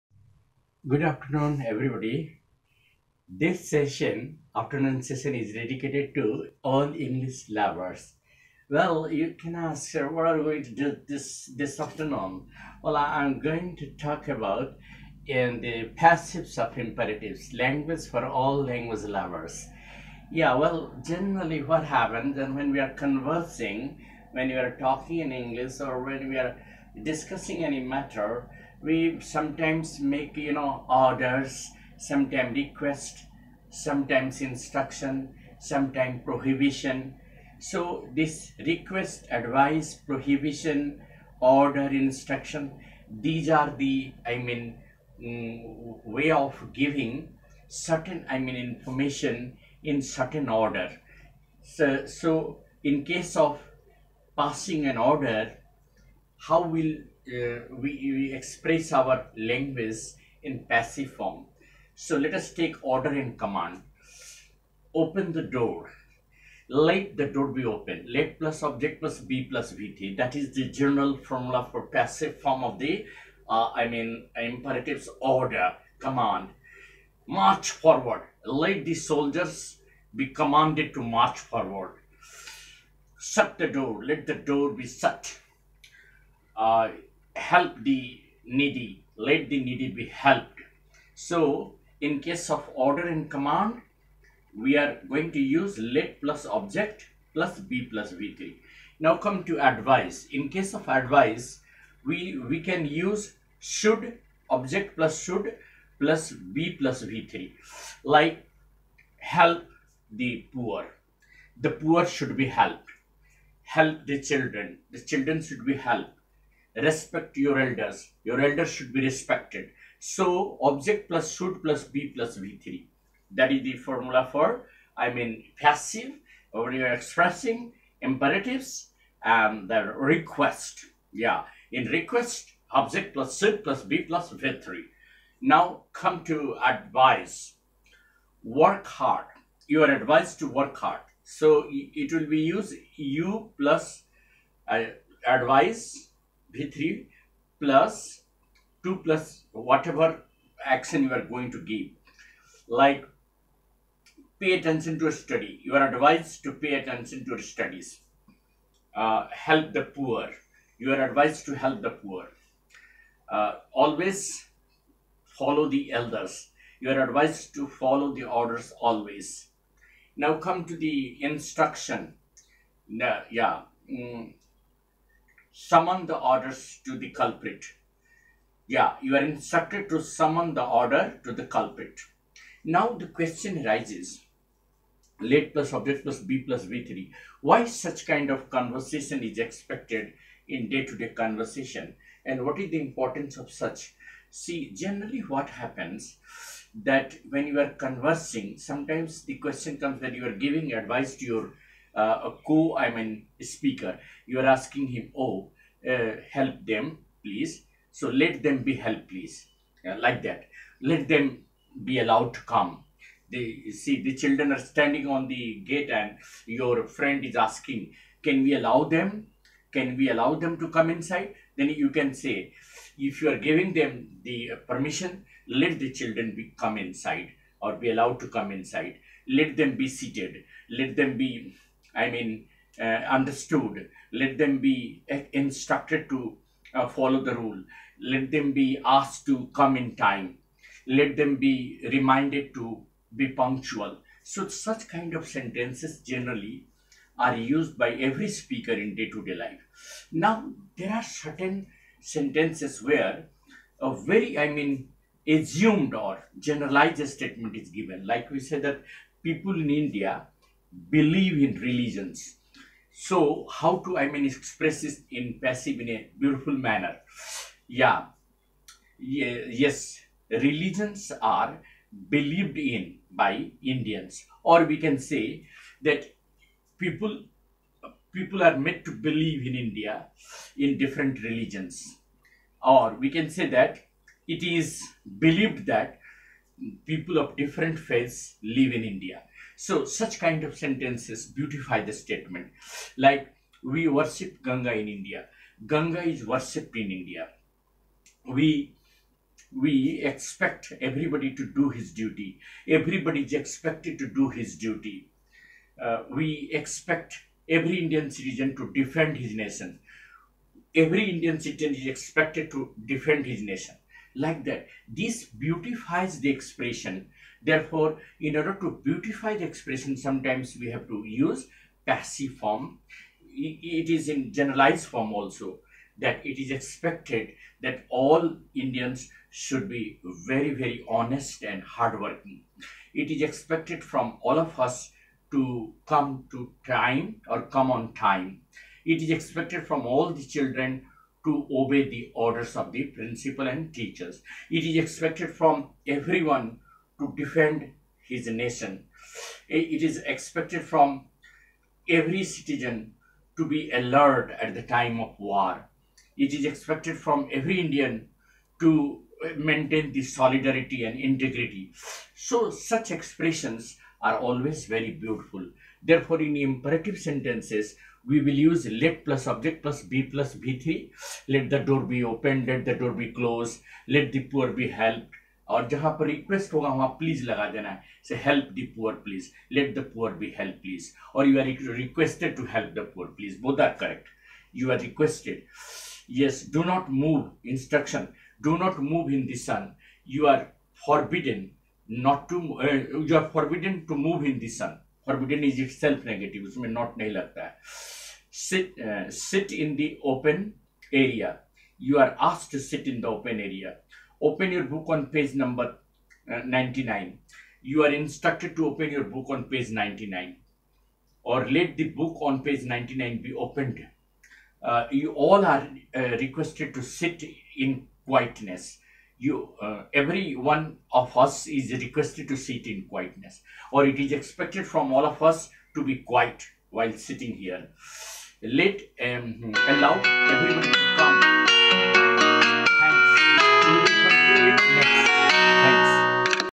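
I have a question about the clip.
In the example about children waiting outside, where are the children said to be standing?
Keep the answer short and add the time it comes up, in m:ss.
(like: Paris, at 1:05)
on the gate, at 3:35.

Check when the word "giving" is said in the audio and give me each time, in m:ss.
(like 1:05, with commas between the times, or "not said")
0:46, 3:20, 3:43.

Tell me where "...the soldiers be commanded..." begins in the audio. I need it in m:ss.
1:18.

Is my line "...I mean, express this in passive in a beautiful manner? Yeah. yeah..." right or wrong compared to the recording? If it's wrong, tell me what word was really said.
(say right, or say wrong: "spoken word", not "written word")
right.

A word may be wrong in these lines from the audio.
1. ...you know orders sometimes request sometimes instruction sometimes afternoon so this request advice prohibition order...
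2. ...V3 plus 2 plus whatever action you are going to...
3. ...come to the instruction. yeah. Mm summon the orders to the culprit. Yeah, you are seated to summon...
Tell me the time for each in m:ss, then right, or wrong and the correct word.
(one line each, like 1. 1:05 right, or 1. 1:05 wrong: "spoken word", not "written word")
1. 0:30 wrong: "prohibition", not "afternoon"
2. 2:26 right
3. 2:50 wrong: "instructed", not "seated".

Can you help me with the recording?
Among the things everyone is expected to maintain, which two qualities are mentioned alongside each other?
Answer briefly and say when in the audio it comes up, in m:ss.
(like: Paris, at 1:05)
solidarity and integrity, at 6:00.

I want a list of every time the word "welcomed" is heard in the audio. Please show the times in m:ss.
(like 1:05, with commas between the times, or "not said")
not said.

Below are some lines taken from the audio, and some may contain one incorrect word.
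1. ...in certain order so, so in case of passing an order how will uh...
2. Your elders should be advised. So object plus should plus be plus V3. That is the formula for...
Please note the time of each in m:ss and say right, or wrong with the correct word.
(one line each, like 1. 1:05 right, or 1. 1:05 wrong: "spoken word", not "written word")
1. 0:49 right
2. 1:58 wrong: "respected", not "advised".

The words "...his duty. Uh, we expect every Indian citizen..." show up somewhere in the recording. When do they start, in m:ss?
5:04.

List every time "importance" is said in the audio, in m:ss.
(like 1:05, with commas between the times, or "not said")
3:12.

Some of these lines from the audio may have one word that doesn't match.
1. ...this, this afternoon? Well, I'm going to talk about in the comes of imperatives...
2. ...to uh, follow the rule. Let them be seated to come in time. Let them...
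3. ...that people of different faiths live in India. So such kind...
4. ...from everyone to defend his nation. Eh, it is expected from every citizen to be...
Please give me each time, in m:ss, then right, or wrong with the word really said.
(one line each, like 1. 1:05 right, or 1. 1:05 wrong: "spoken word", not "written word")
1. 0:11 wrong: "passives", not "comes"
2. 3:56 wrong: "asked", not "seated"
3. 4:45 right
4. 5:45 right.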